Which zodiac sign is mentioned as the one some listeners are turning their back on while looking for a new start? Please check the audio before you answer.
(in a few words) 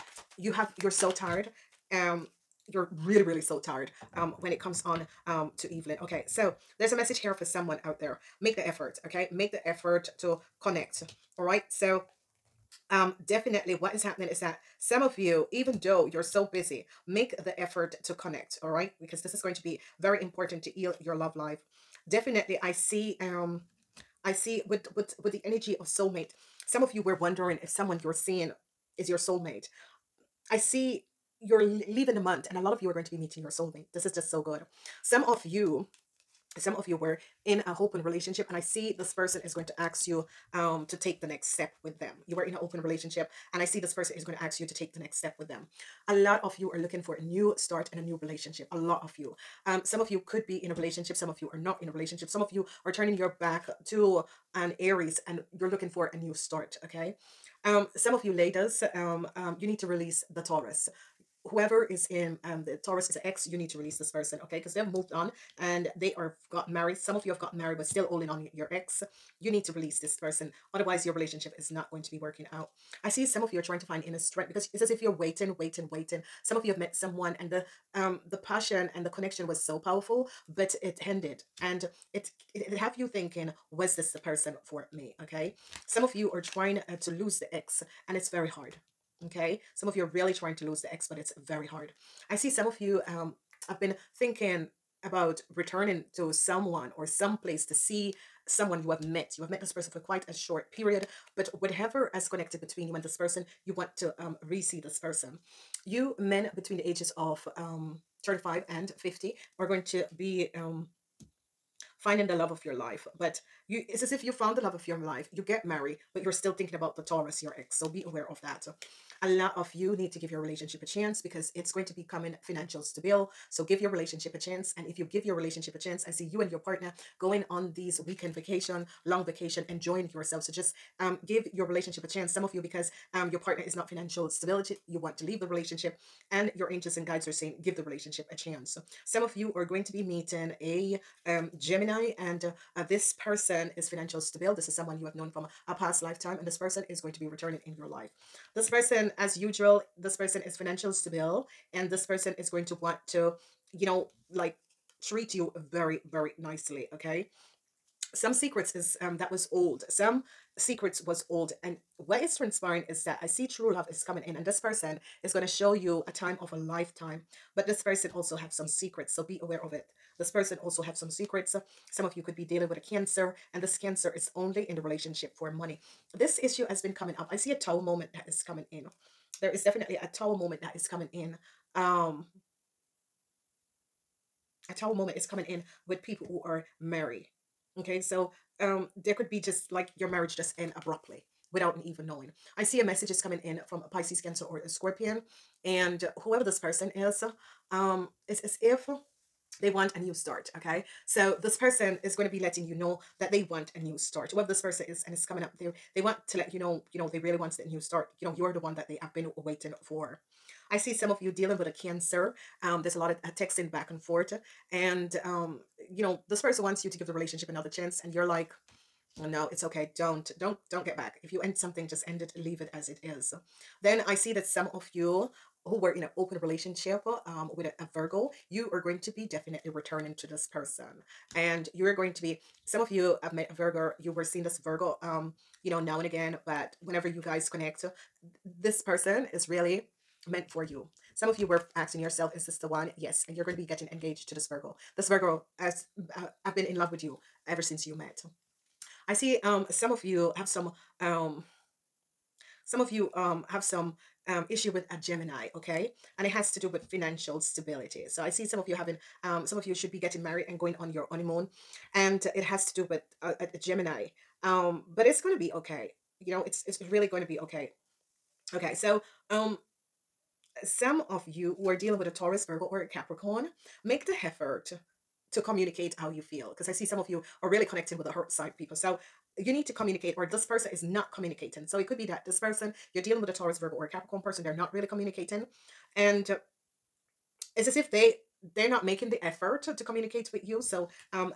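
Aries.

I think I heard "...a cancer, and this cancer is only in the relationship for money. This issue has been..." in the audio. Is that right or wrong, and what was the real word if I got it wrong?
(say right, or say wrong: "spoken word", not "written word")
right.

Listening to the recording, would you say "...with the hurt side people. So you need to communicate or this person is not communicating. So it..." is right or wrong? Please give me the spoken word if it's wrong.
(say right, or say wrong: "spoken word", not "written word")
right.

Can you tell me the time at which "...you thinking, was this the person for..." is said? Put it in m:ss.
1:22.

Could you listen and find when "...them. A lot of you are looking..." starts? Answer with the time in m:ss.
0:45.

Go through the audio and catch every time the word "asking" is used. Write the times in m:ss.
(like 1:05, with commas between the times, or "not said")
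4:01.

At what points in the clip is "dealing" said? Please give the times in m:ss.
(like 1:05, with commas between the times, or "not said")
2:52, 3:31, 4:31, 4:43.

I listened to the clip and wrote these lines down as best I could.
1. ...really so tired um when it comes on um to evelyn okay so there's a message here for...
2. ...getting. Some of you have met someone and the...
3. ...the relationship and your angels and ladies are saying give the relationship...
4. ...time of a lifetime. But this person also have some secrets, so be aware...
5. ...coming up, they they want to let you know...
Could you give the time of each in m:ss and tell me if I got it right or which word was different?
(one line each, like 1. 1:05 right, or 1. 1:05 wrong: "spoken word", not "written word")
1. 0:03 right
2. 1:15 wrong: "waiting", not "getting"
3. 2:15 wrong: "guides", not "ladies"
4. 2:46 right
5. 3:25 right.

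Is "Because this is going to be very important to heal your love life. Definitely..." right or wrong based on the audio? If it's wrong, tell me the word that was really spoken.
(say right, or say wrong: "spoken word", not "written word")
right.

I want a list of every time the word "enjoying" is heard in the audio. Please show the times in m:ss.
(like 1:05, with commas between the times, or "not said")
2:09.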